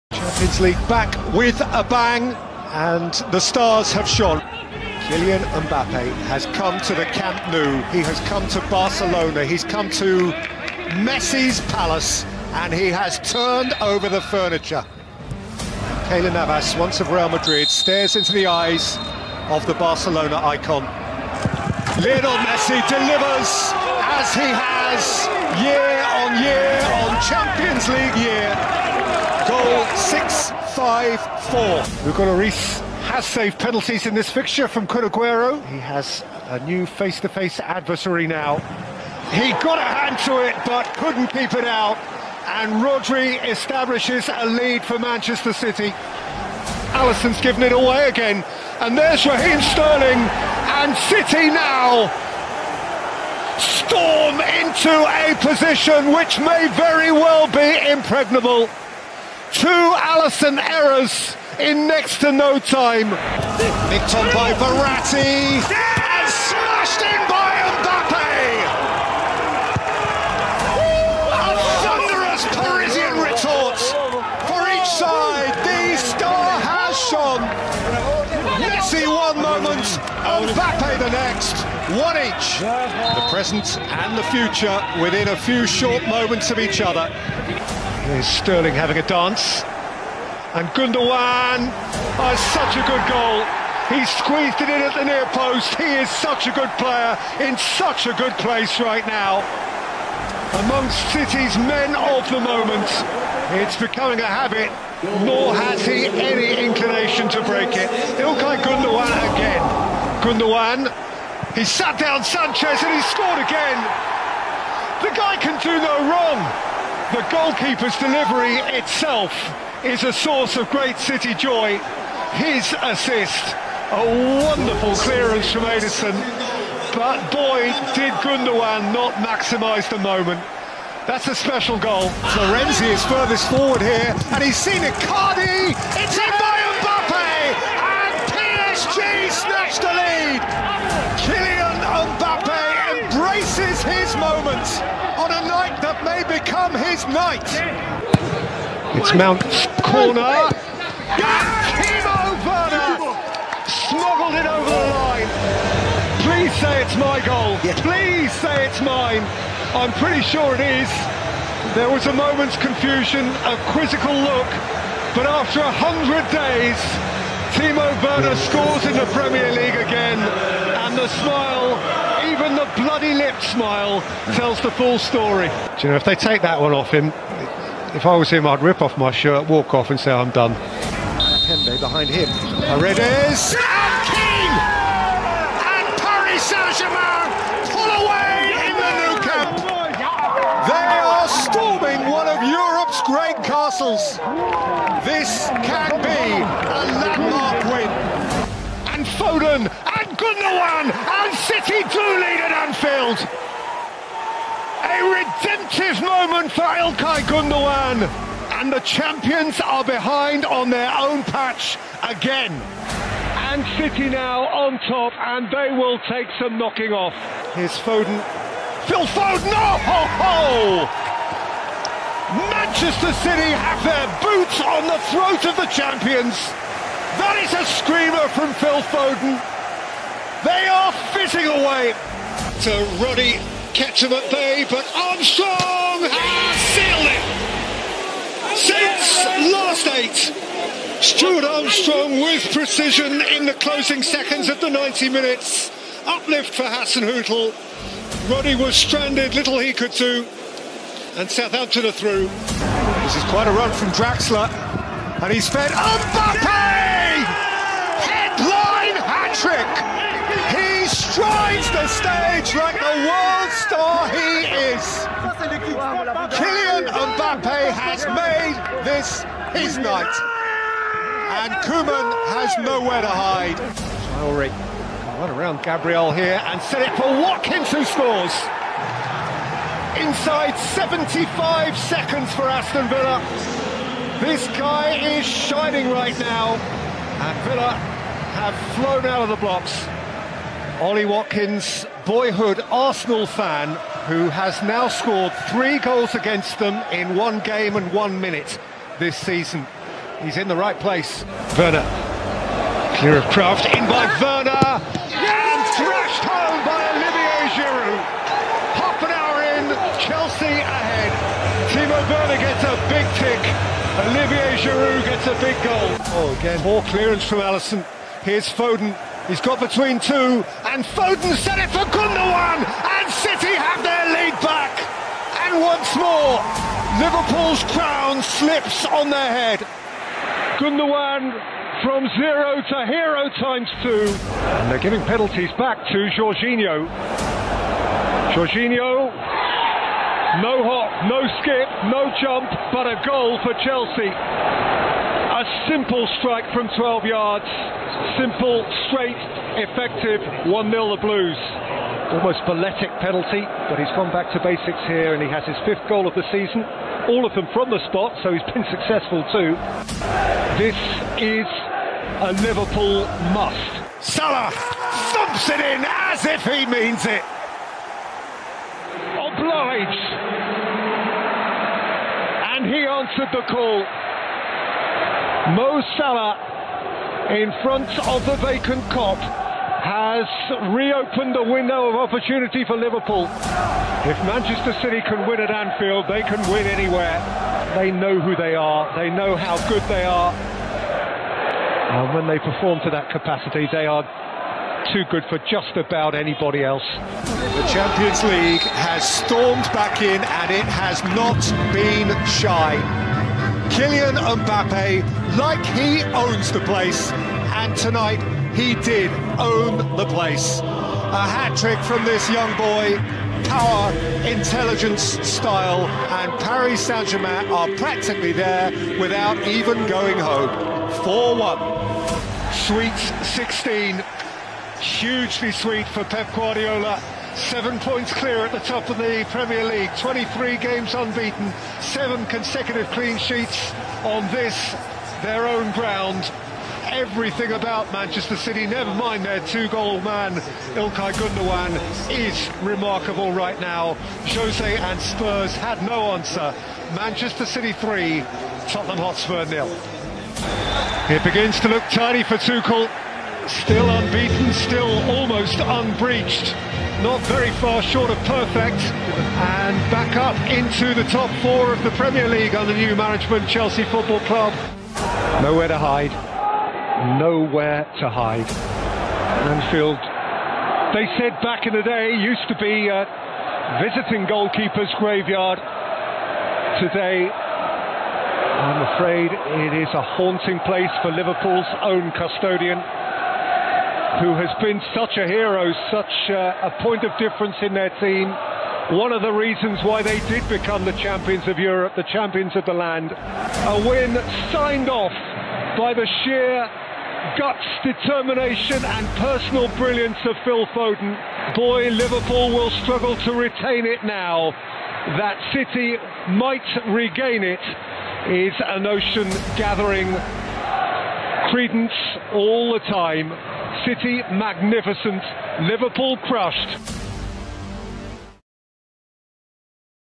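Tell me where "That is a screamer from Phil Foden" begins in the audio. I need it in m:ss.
3:47.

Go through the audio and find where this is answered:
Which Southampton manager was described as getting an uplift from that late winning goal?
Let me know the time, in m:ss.
4:06.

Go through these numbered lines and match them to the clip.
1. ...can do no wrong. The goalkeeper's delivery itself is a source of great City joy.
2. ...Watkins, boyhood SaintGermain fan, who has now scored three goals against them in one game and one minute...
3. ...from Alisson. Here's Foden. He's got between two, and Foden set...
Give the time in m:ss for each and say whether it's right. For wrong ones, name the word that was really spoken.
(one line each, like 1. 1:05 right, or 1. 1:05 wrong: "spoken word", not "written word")
1. 1:55 right
2. 4:51 wrong: "Arsenal", not "SaintGermain"
3. 5:17 right.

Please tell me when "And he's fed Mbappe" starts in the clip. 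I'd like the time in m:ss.
4:15.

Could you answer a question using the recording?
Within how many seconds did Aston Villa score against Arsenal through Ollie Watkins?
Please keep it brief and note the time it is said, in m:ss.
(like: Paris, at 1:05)
75 seconds, at 4:40.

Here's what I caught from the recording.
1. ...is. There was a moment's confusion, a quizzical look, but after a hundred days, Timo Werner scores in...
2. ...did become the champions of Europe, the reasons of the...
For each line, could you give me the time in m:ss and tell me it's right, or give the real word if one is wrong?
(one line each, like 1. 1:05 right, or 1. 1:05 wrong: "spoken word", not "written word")
1. 2:40 right
2. 8:10 wrong: "champions", not "reasons".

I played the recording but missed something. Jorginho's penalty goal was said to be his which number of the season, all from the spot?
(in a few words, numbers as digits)
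5th.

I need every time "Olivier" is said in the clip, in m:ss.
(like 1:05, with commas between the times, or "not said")
5:06, 5:14.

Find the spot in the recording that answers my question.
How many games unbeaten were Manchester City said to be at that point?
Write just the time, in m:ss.
7:09.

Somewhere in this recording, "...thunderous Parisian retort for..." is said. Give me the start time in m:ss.
1:11.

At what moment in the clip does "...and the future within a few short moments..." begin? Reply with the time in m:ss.
1:23.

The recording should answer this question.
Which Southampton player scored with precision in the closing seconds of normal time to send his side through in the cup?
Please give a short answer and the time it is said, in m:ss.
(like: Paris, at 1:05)
Stuart Armstrong, at 4:01.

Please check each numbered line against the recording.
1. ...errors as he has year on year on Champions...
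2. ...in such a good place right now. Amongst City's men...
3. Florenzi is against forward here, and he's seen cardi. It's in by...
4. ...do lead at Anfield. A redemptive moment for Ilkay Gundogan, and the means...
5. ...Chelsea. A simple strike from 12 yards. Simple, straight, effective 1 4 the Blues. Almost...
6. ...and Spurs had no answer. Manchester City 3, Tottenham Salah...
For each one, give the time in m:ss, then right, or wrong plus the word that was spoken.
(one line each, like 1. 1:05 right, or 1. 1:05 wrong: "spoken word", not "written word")
1. 0:22 wrong: "delivers", not "errors"
2. 1:37 right
3. 2:12 wrong: "furthest", not "against"
4. 3:21 wrong: "champions", not "means"
5. 5:43 wrong: "0", not "4"
6. 7:24 wrong: "Hotspur", not "Salah".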